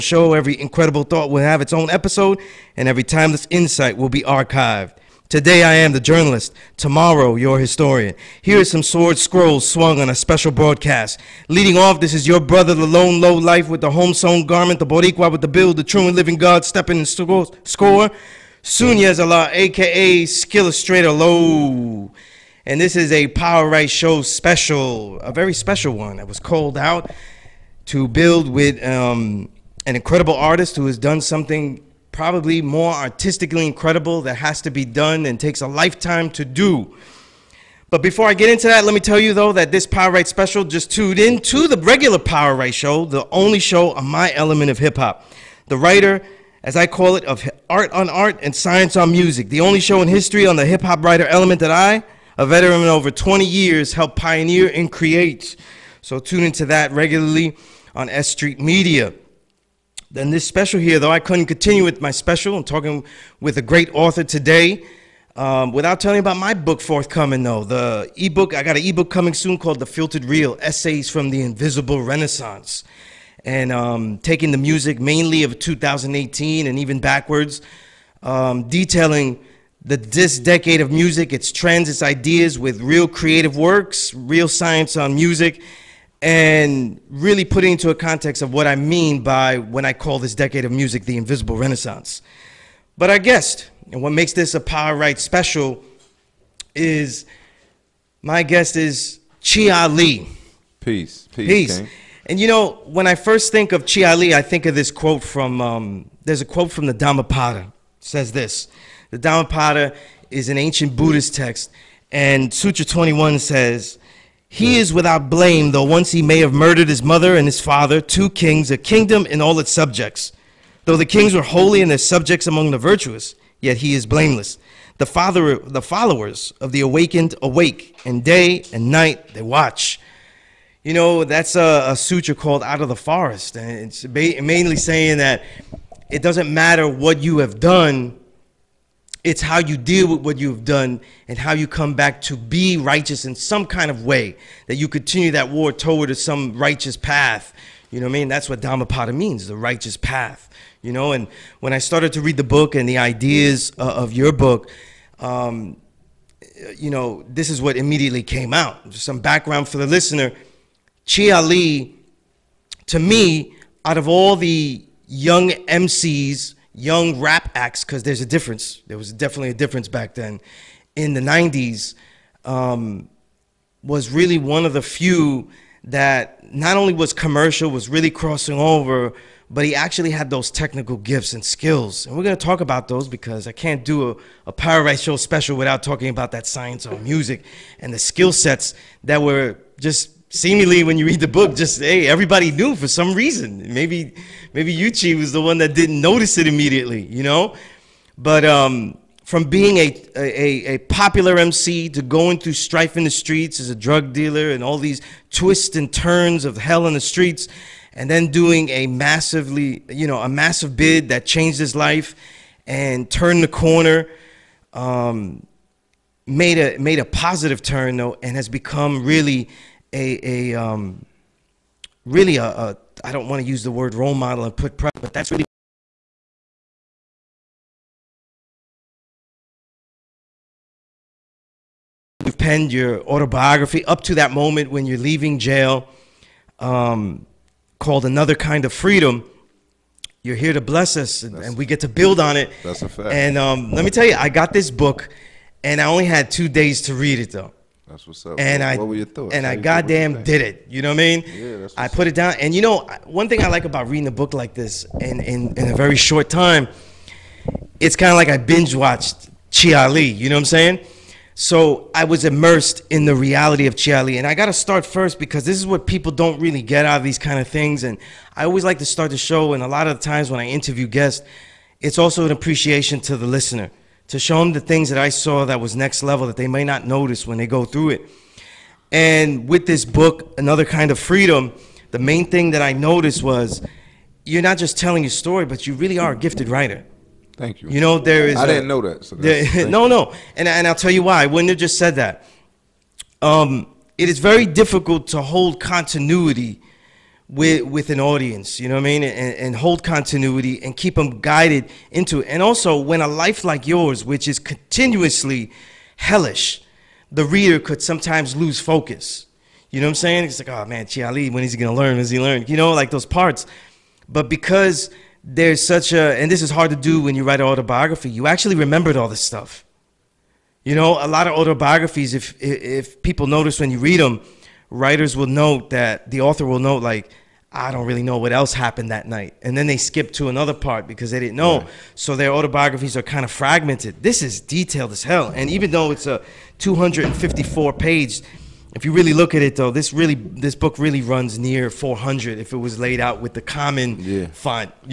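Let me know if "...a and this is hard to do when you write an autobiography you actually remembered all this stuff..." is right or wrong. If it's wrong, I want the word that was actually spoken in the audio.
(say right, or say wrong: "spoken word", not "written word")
right.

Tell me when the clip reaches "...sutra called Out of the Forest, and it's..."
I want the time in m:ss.
2:11.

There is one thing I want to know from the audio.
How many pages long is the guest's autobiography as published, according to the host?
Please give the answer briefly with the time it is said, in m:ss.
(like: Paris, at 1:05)
254, at 5:36.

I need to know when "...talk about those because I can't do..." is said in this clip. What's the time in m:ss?
3:02.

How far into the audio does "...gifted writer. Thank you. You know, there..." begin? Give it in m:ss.
4:46.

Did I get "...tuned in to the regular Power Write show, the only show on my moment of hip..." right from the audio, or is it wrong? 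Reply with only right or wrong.
wrong.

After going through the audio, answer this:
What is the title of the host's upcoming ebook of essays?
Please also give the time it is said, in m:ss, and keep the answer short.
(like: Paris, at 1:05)
The Filtered Real, at 1:09.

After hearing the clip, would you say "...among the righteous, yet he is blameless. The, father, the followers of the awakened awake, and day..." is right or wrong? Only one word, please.
wrong.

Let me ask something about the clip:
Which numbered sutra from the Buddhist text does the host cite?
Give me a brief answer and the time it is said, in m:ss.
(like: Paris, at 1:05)
21, at 1:52.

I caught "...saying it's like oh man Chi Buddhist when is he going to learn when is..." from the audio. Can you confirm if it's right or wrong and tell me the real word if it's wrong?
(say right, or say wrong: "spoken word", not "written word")
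wrong: "Ali", not "Buddhist".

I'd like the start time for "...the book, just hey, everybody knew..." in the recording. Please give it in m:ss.
3:11.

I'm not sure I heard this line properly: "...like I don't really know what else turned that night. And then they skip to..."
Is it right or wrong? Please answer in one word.
wrong.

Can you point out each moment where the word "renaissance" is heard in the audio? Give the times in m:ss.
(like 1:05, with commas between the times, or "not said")
1:12, 1:31.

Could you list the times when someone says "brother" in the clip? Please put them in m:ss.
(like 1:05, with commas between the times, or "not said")
0:12.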